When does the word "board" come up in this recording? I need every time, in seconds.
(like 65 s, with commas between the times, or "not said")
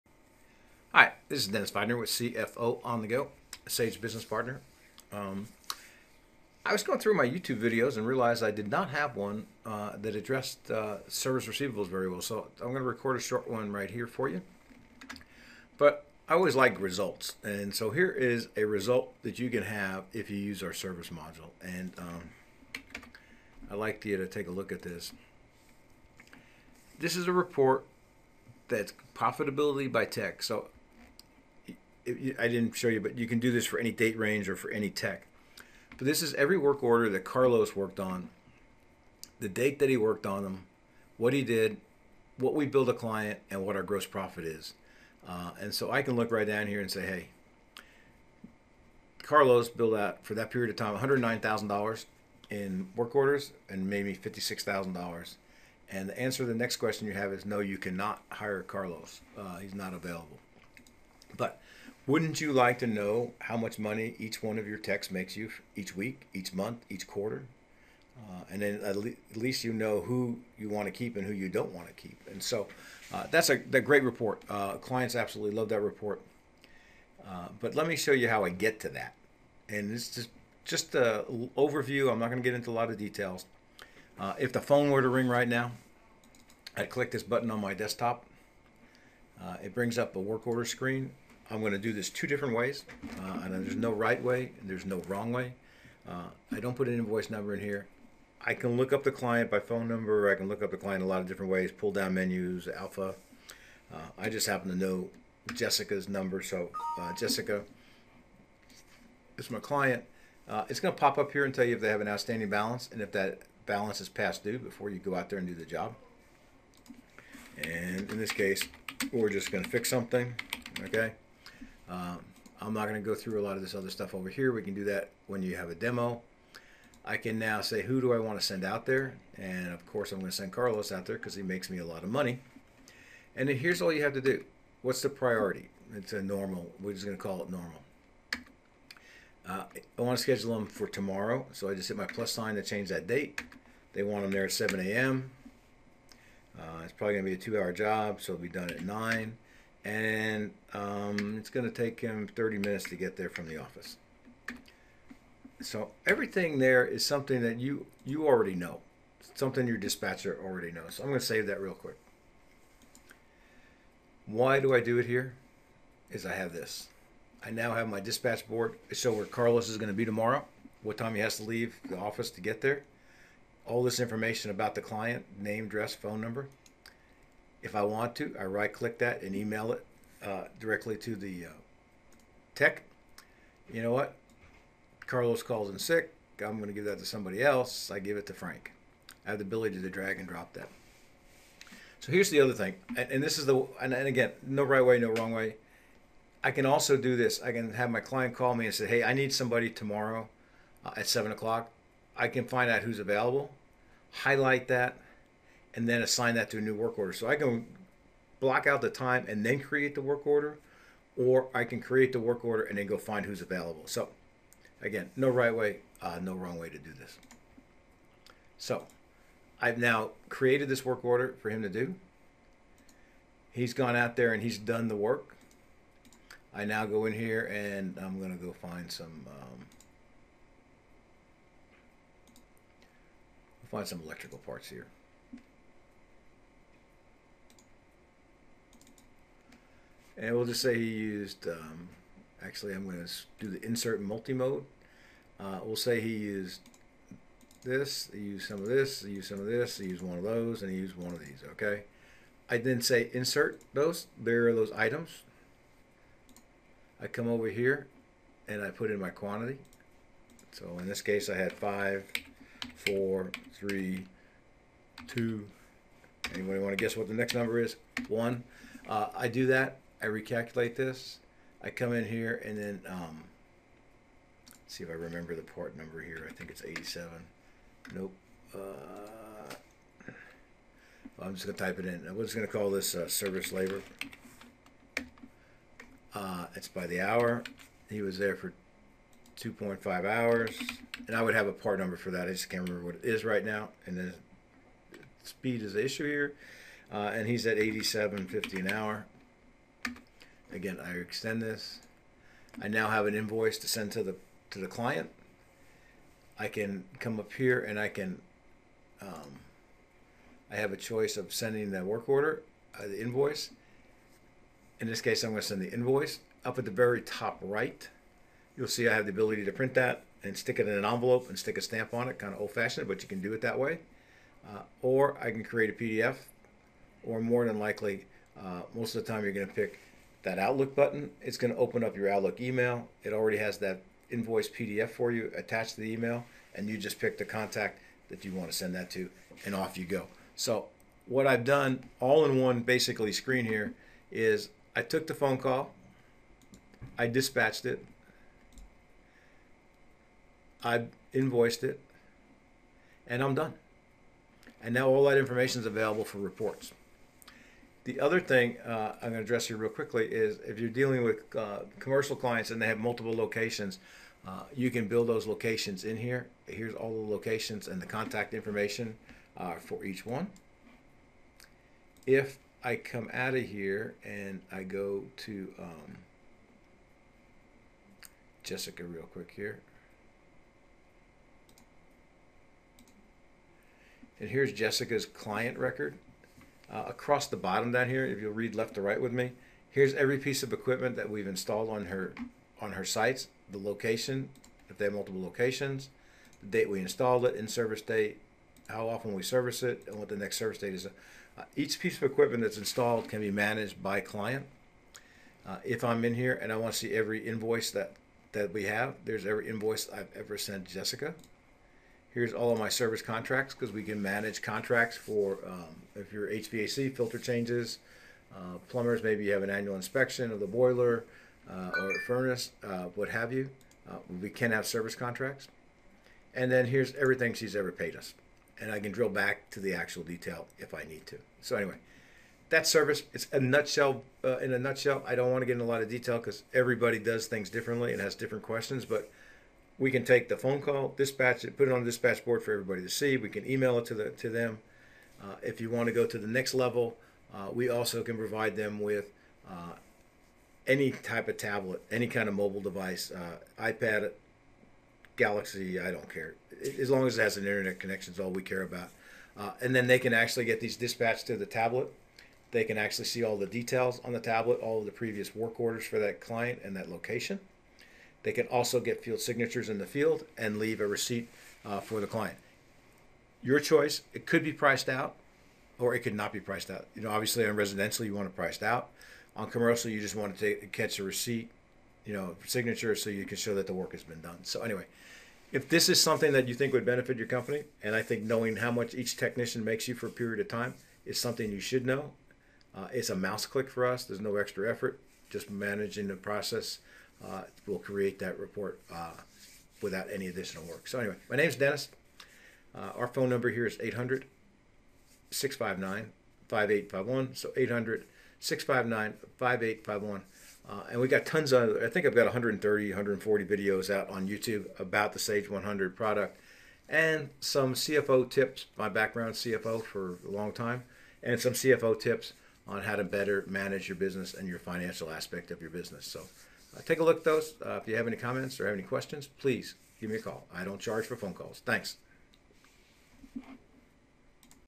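168 s, 442 s.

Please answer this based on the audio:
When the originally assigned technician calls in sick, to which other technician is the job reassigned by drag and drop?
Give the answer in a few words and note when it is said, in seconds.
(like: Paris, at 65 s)
Frank, at 188 s.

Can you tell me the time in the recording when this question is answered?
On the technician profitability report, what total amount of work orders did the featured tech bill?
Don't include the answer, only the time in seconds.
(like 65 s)
50 s.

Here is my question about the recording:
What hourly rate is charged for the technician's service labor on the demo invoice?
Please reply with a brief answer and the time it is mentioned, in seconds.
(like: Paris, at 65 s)
87.50, at 297 s.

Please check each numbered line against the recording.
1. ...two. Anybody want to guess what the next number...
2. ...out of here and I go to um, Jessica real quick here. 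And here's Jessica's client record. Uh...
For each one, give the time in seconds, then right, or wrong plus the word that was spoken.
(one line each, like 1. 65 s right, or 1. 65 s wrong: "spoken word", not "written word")
1. 265 s right
2. 373 s right.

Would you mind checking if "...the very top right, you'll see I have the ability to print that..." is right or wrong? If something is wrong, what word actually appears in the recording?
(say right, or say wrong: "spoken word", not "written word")
right.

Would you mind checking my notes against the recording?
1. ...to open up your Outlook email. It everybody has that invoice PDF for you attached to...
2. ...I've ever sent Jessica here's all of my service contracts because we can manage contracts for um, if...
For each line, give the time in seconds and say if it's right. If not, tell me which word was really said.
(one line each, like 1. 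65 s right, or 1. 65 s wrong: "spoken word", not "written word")
1. 331 s wrong: "already", not "everybody"
2. 409 s right.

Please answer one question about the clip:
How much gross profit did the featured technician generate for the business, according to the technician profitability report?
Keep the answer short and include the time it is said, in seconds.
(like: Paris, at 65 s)
$56,000, at 54 s.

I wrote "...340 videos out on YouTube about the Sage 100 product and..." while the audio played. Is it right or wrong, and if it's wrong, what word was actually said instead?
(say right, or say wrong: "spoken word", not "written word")
wrong: "140", not "340".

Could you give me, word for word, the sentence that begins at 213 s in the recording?
So again, no right way, uh, no wrong way to do this.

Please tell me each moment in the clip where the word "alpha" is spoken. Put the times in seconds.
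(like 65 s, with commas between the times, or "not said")
102 s.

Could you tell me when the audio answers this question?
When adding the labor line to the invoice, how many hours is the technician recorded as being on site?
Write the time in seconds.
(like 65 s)
289 s.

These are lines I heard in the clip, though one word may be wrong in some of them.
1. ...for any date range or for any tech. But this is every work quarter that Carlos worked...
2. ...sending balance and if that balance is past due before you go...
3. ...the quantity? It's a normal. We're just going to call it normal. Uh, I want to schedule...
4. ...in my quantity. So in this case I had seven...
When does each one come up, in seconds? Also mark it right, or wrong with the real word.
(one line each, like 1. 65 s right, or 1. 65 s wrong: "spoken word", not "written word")
1. 33 s wrong: "order", not "quarter"
2. 112 s wrong: "outstanding", not "sending"
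3. 135 s wrong: "priority", not "quantity"
4. 258 s wrong: "five", not "seven".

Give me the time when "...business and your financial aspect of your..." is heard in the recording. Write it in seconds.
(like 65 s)
523 s.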